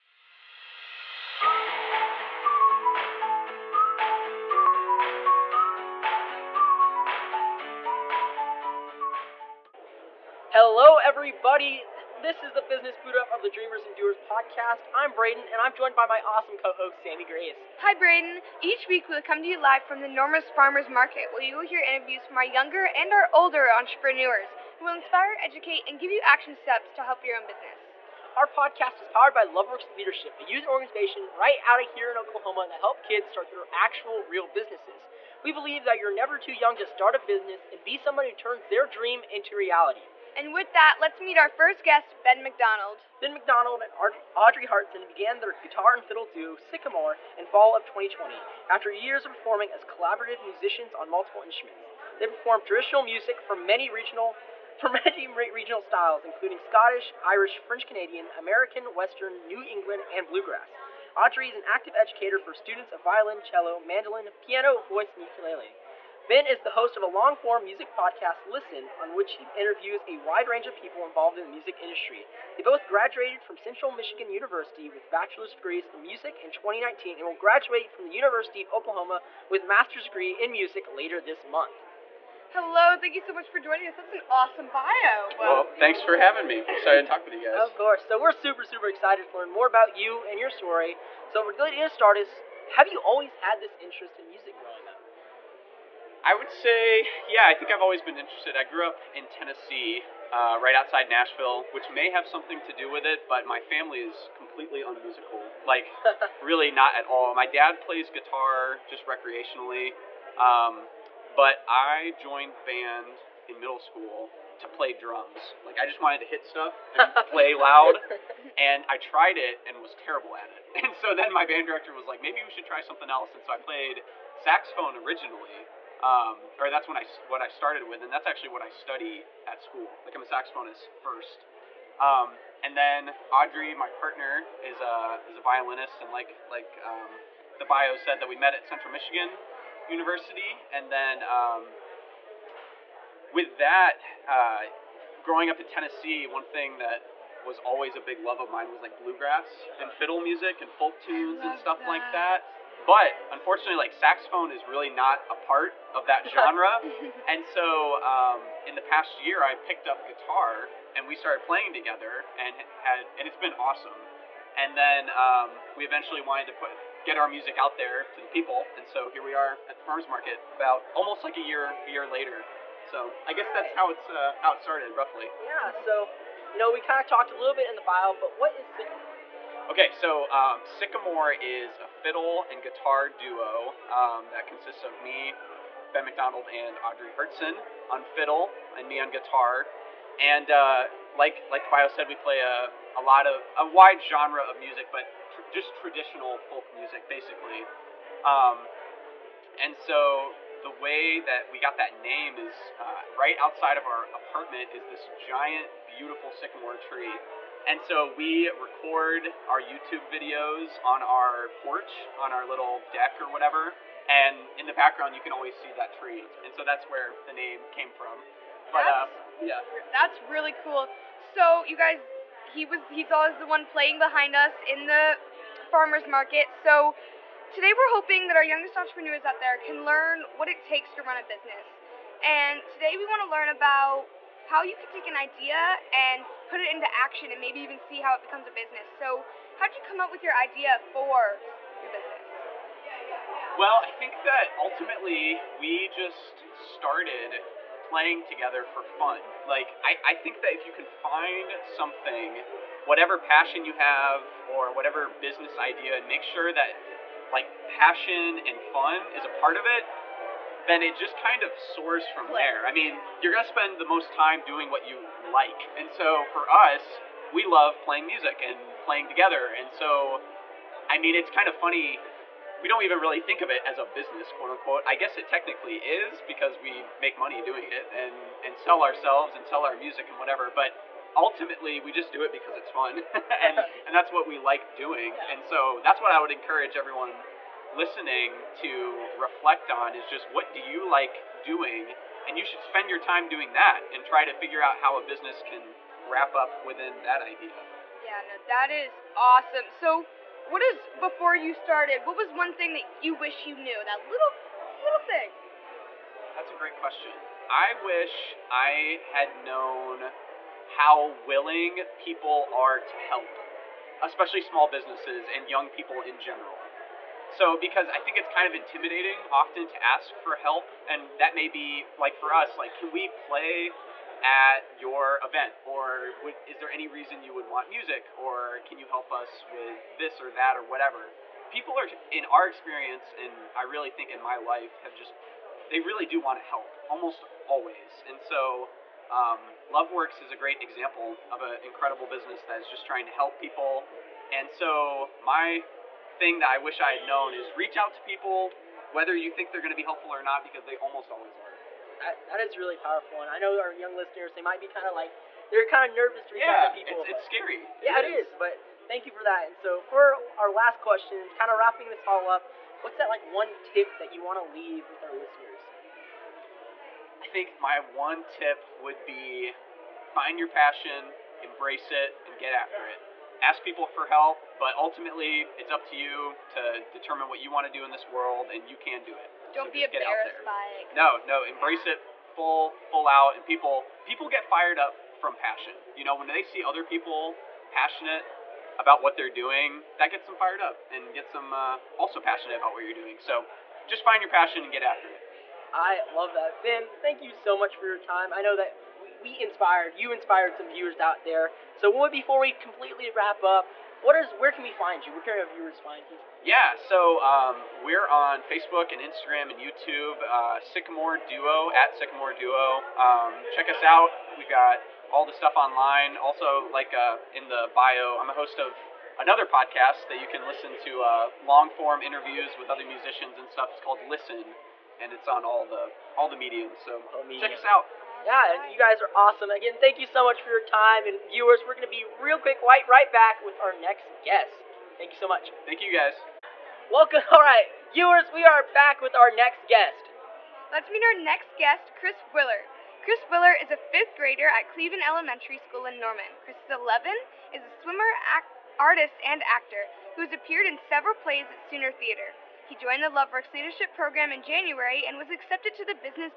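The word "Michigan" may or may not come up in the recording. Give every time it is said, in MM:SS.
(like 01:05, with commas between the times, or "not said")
01:13, 02:18.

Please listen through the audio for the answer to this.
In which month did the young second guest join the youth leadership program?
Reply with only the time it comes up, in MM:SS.
07:34.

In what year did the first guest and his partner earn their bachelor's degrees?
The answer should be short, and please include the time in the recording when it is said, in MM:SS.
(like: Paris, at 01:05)
2019, at 01:16.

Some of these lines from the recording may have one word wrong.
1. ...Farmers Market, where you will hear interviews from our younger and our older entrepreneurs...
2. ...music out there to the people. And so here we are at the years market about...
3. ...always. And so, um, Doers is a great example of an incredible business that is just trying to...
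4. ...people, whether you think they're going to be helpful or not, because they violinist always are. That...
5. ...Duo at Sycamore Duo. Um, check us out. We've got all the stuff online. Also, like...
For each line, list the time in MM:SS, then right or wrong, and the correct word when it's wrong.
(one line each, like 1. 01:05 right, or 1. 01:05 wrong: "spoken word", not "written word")
1. 00:20 right
2. 02:47 wrong: "farmers", not "years"
3. 05:37 wrong: "Loveworks", not "Doers"
4. 05:48 wrong: "almost", not "violinist"
5. 06:51 right.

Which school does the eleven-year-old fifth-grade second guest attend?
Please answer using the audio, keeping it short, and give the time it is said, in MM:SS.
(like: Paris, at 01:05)
Cleveland Elementary School, at 07:24.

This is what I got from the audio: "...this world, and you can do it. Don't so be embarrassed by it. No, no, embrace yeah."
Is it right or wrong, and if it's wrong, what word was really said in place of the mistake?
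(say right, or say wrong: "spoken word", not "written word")
right.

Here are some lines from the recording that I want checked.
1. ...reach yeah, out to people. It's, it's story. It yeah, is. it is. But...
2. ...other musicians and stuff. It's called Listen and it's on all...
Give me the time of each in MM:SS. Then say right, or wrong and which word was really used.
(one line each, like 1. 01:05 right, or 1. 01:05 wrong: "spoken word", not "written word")
1. 05:56 wrong: "scary", not "story"
2. 07:02 right.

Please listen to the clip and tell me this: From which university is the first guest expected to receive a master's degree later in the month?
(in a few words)
University of Oklahoma.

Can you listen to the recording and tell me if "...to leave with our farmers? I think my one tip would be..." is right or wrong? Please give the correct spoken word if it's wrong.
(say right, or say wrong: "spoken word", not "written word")
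wrong: "listeners", not "farmers".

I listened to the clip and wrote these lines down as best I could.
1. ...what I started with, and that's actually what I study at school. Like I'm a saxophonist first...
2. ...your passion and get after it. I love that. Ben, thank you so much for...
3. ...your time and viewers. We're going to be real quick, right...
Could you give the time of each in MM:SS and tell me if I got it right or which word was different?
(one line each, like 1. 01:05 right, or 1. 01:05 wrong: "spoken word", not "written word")
1. 02:07 right
2. 06:34 right
3. 07:10 right.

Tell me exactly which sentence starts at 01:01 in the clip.
Audrey is an active educator for students of violin, cello, mandolin, piano, voice, and ukulele.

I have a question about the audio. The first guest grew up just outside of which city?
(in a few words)
Nashville.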